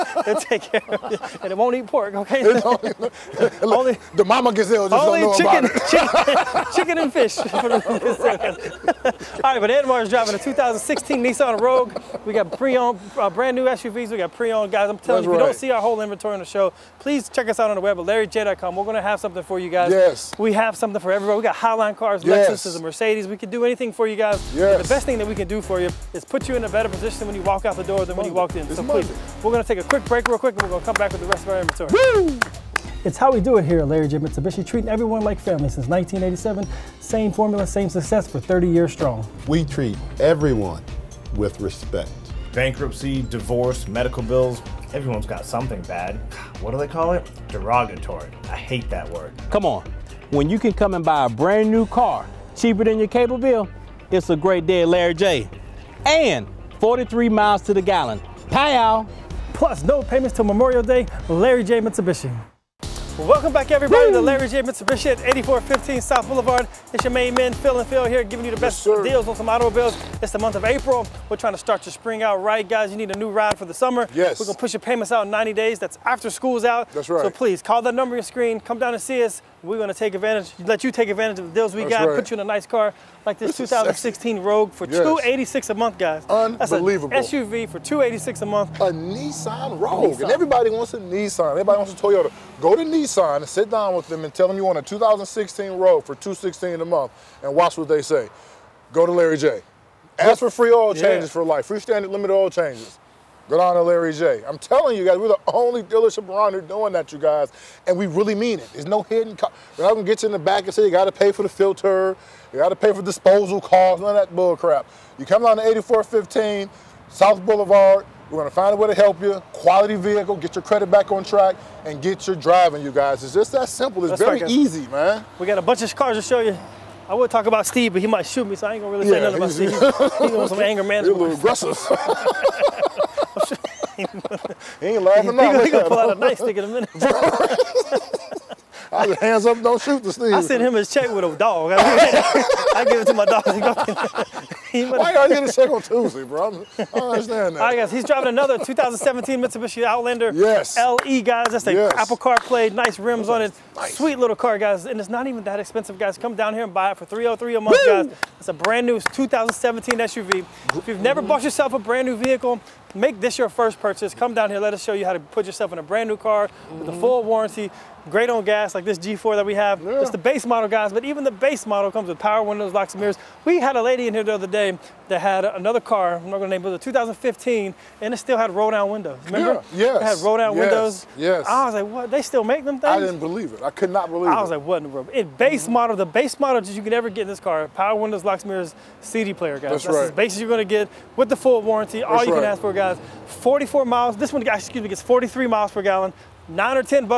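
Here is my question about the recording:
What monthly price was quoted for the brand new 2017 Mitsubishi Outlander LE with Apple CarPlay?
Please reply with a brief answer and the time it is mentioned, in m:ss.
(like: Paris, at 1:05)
$303 a month, at 2:37.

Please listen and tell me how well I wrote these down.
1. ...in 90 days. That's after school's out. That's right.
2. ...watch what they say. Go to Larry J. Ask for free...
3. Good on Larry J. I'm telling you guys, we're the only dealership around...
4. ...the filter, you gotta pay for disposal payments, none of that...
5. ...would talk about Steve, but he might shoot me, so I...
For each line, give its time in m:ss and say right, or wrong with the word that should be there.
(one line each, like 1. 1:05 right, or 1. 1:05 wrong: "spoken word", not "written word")
1. 1:15 right
2. 1:37 right
3. 1:43 right
4. 1:51 wrong: "costs", not "payments"
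5. 2:07 right.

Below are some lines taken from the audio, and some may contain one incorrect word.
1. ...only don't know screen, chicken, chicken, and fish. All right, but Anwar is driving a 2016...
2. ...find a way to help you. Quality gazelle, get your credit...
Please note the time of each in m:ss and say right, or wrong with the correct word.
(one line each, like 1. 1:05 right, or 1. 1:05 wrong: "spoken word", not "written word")
1. 0:05 wrong: "chicken", not "screen"
2. 1:58 wrong: "vehicle", not "gazelle".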